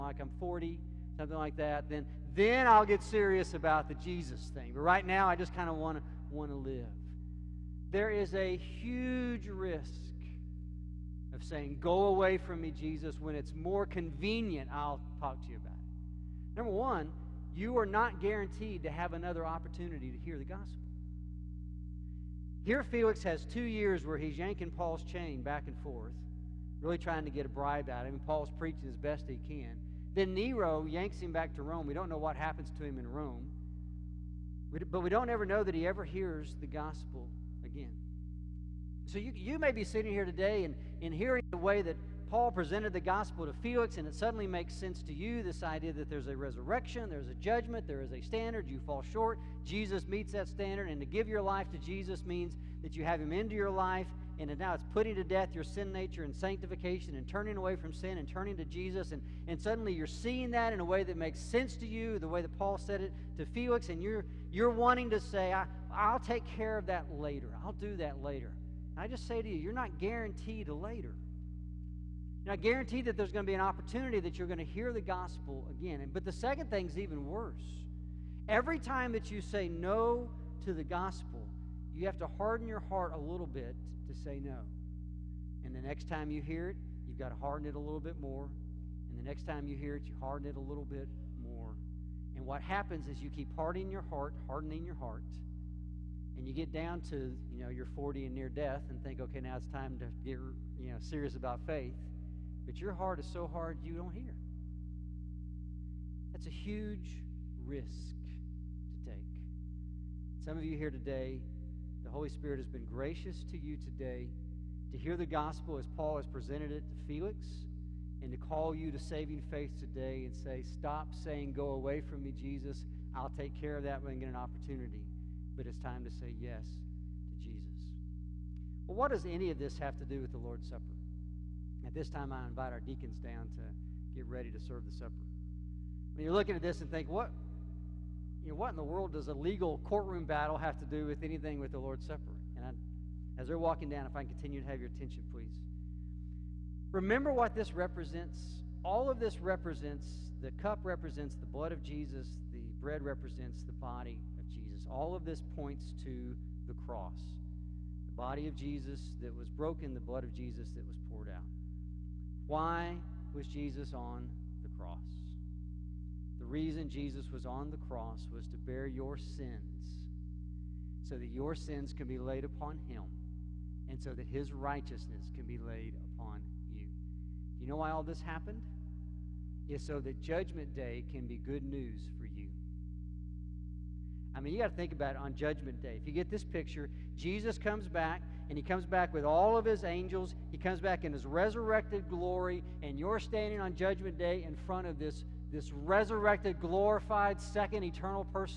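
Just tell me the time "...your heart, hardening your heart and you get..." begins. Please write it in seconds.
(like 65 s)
93 s.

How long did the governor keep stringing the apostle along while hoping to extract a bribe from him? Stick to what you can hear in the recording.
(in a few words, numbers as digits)
2 years.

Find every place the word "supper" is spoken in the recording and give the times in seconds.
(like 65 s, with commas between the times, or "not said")
130 s, 134 s, 142 s.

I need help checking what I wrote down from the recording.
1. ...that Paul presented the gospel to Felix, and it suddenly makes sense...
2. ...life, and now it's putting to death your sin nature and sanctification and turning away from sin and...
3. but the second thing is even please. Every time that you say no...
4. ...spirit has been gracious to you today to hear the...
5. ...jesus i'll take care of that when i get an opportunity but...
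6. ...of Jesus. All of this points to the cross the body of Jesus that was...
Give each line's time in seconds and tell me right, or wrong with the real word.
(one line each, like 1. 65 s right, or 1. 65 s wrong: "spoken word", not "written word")
1. 41 s right
2. 53 s right
3. 76 s wrong: "worse", not "please"
4. 112 s right
5. 122 s right
6. 154 s right.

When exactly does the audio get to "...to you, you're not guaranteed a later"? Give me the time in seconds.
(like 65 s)
69 s.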